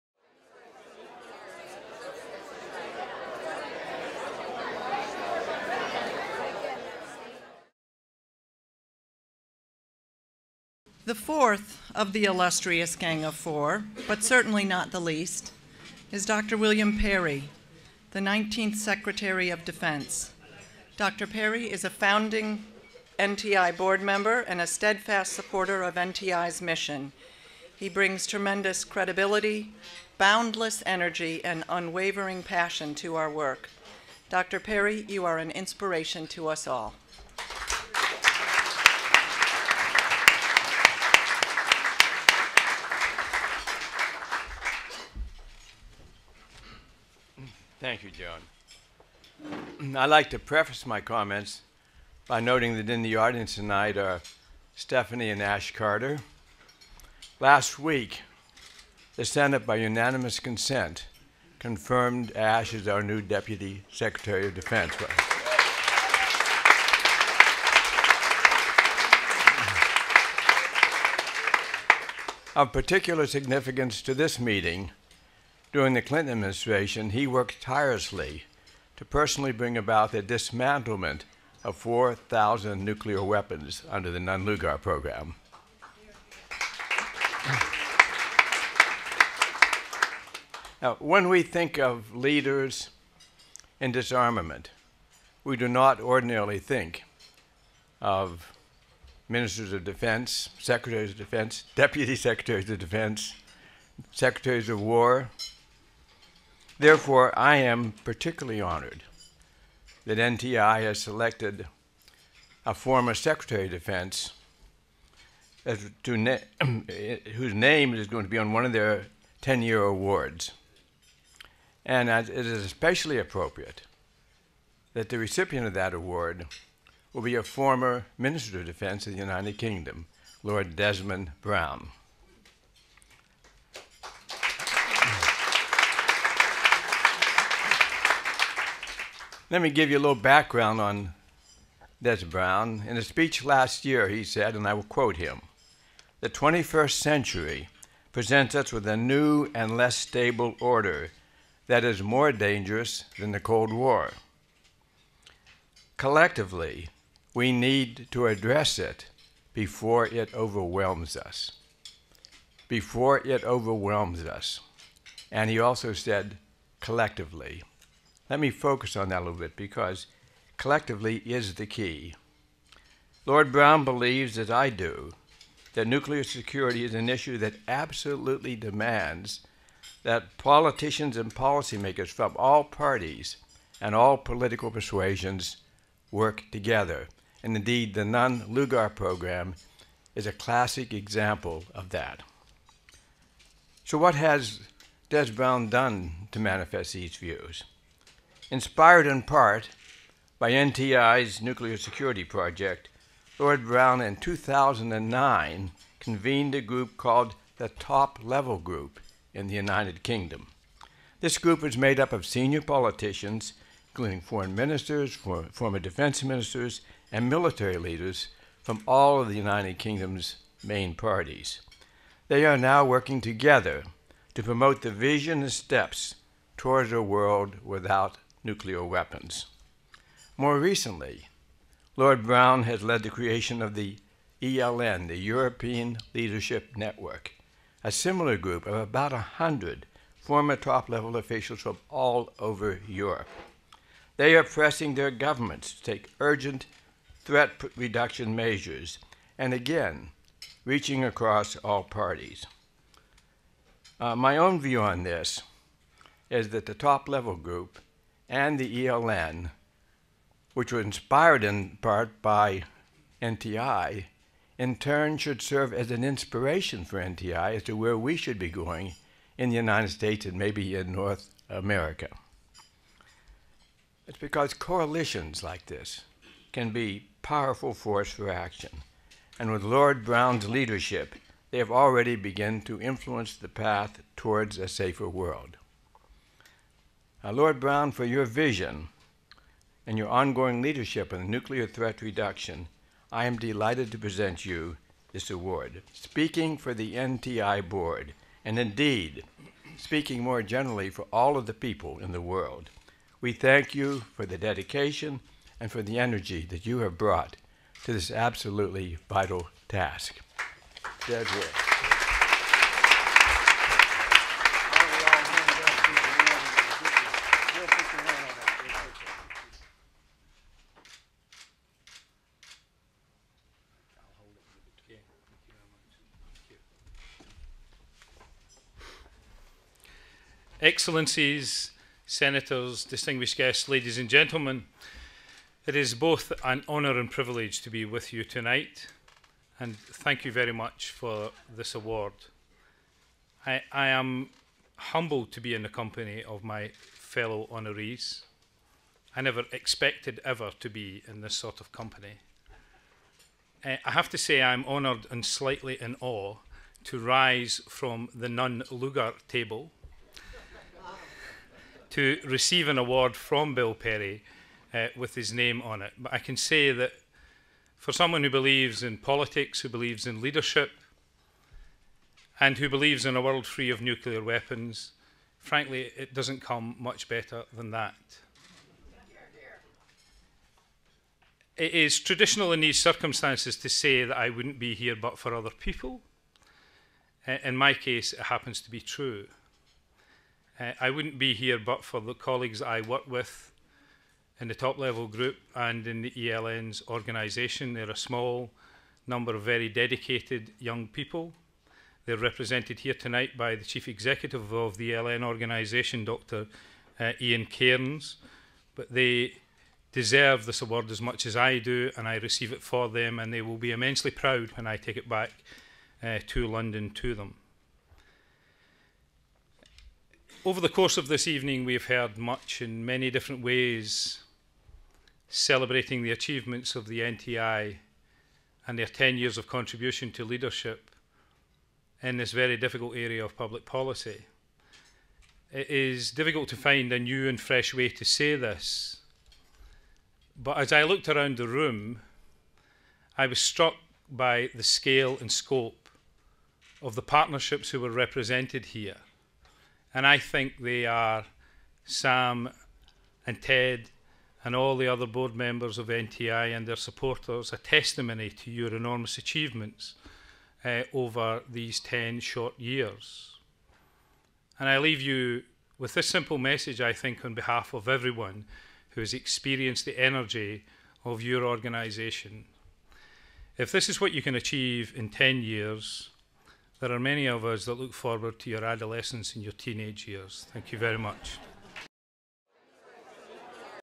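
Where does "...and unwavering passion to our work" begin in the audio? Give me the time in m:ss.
0:31.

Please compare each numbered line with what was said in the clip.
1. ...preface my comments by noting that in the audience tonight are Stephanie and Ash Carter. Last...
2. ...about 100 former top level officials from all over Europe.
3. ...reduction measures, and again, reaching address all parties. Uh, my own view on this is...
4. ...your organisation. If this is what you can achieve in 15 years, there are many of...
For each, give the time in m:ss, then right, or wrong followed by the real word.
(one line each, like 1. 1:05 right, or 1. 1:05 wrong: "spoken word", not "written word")
1. 0:50 right
2. 3:58 right
3. 4:07 wrong: "across", not "address"
4. 7:51 wrong: "10", not "15".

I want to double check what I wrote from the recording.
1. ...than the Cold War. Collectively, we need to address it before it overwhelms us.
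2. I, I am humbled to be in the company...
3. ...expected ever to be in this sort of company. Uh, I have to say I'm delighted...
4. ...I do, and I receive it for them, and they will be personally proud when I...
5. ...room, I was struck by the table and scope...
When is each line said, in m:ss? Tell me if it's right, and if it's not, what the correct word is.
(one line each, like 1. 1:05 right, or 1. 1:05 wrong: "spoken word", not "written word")
1. 2:33 right
2. 5:43 right
3. 5:49 wrong: "honoured", not "delighted"
4. 6:51 wrong: "immensely", not "personally"
5. 7:21 wrong: "scale", not "table".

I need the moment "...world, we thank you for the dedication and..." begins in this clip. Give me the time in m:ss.
5:02.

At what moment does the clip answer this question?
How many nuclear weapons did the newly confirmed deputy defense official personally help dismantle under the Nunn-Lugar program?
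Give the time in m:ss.
1:21.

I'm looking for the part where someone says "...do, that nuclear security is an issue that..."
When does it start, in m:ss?
2:54.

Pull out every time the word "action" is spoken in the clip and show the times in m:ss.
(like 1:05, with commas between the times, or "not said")
4:38.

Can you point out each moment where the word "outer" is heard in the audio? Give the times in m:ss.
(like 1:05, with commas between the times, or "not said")
not said.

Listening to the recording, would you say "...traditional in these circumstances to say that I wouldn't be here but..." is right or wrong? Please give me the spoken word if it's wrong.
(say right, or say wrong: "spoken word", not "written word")
right.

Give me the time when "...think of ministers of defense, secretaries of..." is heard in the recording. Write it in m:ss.
1:36.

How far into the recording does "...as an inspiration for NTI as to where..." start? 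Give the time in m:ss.
4:25.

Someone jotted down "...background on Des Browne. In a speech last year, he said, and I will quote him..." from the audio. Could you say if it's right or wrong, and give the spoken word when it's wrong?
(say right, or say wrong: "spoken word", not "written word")
right.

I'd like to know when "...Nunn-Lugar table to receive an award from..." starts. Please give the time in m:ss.
5:58.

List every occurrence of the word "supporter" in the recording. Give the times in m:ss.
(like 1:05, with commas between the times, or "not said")
0:25, 7:36.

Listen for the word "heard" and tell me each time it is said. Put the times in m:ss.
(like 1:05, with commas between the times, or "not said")
7:01.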